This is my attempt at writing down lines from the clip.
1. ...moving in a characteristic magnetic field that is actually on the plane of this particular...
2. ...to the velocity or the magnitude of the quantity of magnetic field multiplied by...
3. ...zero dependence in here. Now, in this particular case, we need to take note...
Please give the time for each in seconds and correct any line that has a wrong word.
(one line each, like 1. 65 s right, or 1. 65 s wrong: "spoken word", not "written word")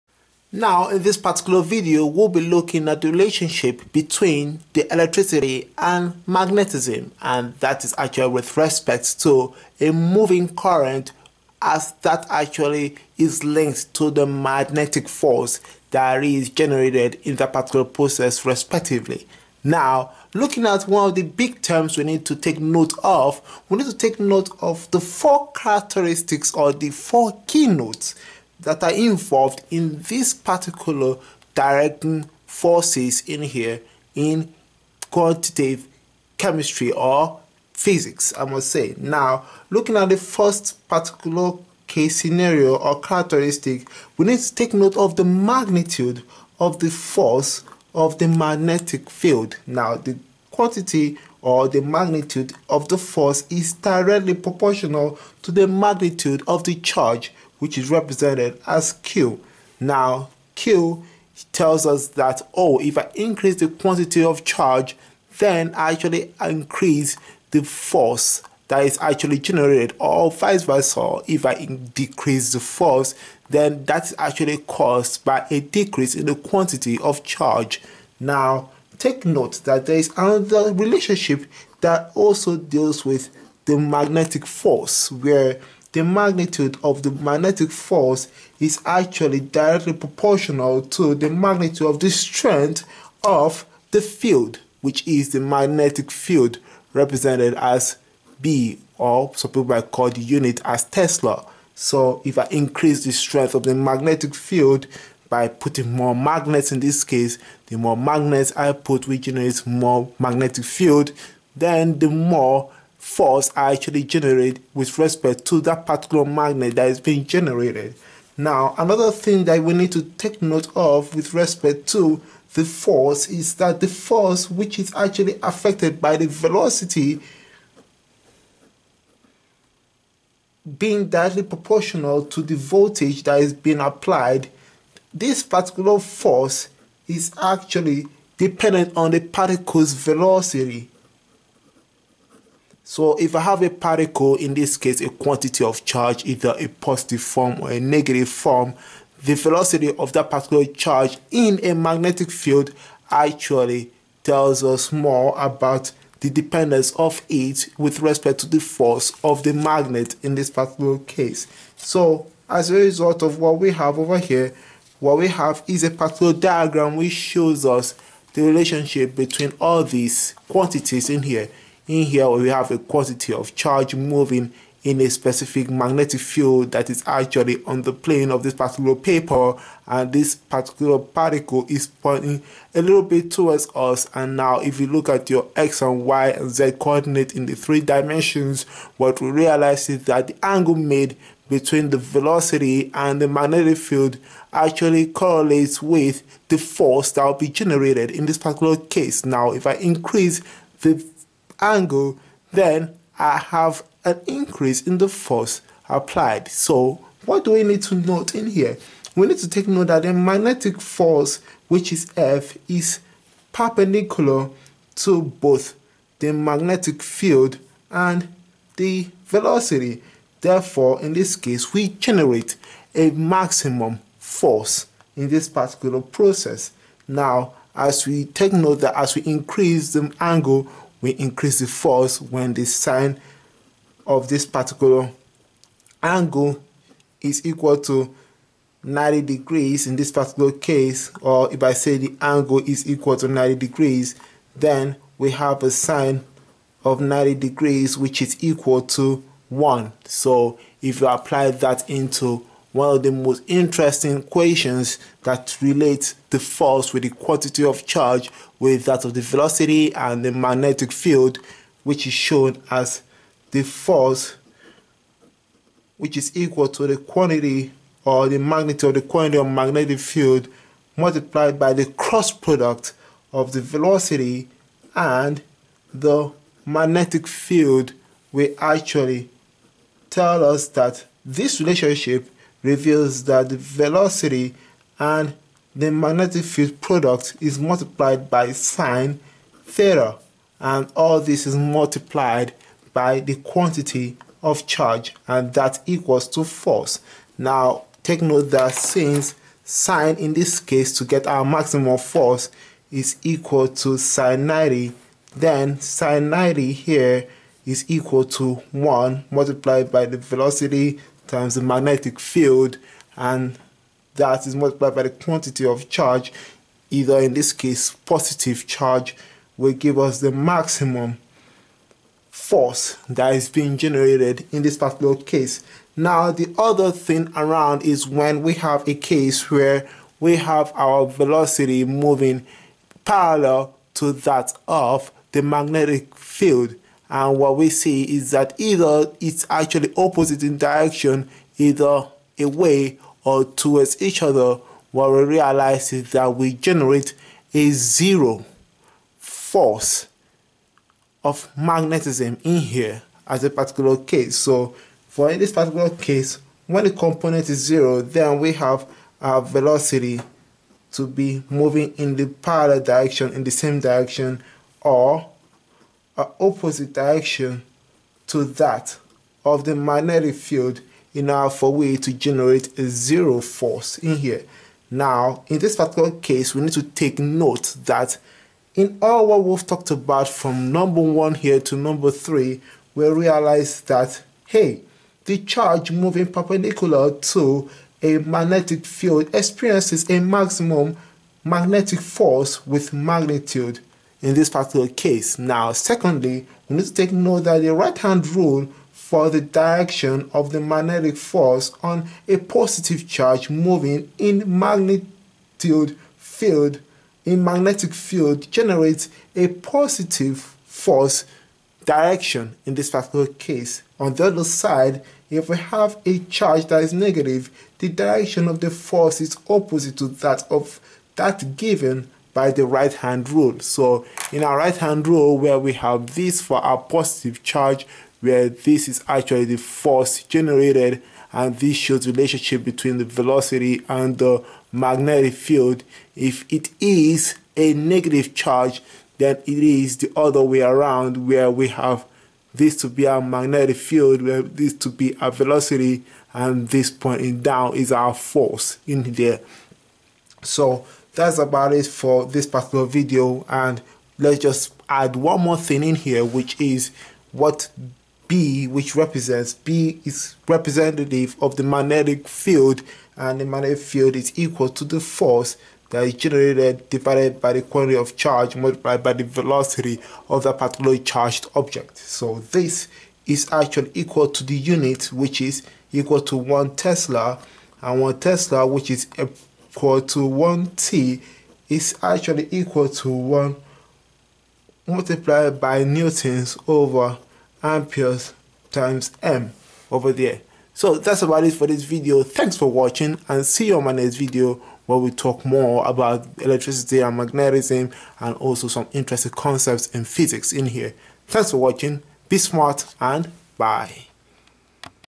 1. 173 s wrong: "specific", not "characteristic"
2. 266 s wrong: "quantity", not "velocity"
3. 372 s wrong: "force", not "dependence".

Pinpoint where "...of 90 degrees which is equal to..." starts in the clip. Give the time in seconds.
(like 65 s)
246 s.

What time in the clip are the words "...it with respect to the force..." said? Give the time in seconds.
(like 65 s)
157 s.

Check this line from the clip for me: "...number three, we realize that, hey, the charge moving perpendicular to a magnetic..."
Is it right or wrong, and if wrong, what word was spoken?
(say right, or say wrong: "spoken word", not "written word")
right.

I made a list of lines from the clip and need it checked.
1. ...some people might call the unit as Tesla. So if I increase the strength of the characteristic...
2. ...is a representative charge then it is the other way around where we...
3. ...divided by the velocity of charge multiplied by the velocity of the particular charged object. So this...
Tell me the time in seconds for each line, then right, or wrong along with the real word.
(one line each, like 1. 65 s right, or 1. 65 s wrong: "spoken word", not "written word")
1. 99 s wrong: "magnetic", not "characteristic"
2. 436 s wrong: "negative", not "representative"
3. 466 s wrong: "quantity", not "velocity".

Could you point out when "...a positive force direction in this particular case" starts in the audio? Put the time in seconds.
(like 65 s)
409 s.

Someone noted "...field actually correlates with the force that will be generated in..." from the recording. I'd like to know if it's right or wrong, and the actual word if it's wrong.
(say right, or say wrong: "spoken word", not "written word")
right.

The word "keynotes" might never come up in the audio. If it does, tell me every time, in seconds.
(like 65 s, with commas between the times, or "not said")
27 s.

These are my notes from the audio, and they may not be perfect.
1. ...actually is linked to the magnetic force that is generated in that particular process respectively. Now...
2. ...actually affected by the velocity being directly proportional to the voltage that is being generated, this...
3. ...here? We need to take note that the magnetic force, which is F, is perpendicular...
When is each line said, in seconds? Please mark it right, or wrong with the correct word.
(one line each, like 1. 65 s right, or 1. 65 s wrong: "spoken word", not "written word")
1. 12 s right
2. 124 s wrong: "applied", not "generated"
3. 208 s right.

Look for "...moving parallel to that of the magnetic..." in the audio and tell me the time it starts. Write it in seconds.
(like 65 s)
331 s.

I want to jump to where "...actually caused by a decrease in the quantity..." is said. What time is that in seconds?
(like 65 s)
74 s.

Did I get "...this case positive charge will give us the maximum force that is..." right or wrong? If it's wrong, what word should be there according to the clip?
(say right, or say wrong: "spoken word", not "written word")
right.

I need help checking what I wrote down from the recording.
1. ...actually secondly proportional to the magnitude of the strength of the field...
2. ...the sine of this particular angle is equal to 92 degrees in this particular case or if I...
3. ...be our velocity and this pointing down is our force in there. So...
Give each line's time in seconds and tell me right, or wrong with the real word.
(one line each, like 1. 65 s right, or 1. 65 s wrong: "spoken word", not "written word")
1. 88 s wrong: "directly", not "secondly"
2. 232 s wrong: "90", not "92"
3. 444 s right.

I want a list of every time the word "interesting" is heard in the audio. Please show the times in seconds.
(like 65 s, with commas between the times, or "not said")
253 s, 498 s.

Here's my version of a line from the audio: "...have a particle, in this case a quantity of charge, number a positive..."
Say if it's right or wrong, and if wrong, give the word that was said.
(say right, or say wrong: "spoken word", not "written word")
wrong: "either", not "number".